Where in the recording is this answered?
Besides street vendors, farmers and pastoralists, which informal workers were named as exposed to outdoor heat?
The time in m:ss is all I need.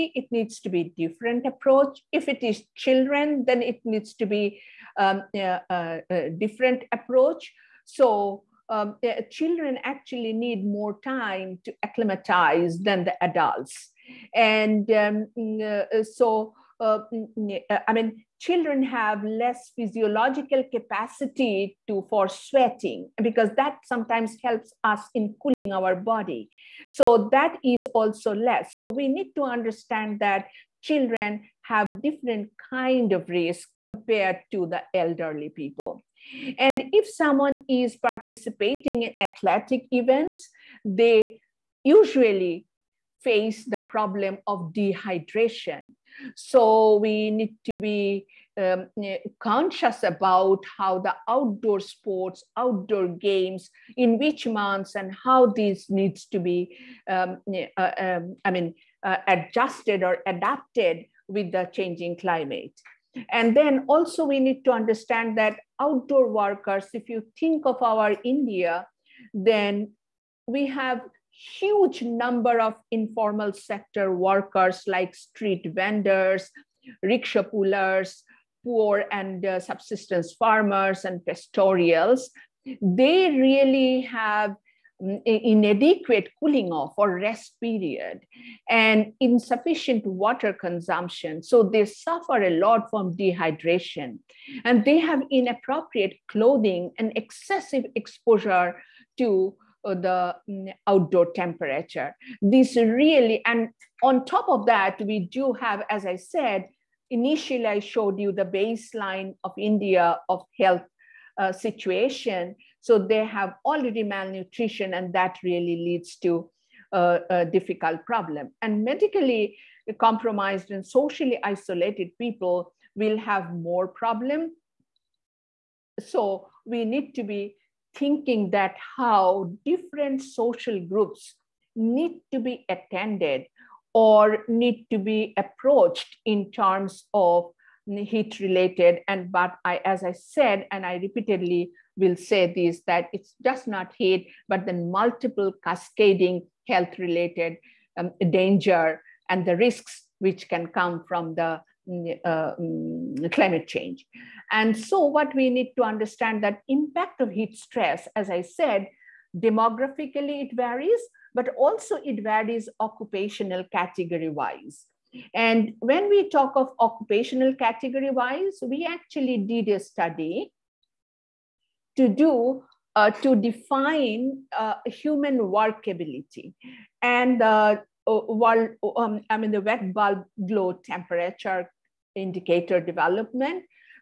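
1:17.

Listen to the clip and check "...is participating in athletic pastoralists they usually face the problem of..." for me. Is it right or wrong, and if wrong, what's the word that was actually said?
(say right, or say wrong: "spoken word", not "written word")
wrong: "events", not "pastoralists".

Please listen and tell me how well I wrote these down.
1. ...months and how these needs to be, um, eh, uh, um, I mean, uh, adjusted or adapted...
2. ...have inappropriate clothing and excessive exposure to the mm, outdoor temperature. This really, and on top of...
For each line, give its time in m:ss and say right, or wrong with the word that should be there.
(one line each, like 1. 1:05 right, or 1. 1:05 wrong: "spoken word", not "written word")
1. 0:54 right
2. 1:34 right.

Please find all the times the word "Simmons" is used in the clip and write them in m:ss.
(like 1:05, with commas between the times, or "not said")
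not said.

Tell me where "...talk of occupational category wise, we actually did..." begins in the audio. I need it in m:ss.
2:46.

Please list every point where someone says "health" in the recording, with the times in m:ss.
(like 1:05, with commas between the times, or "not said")
1:50, 2:26.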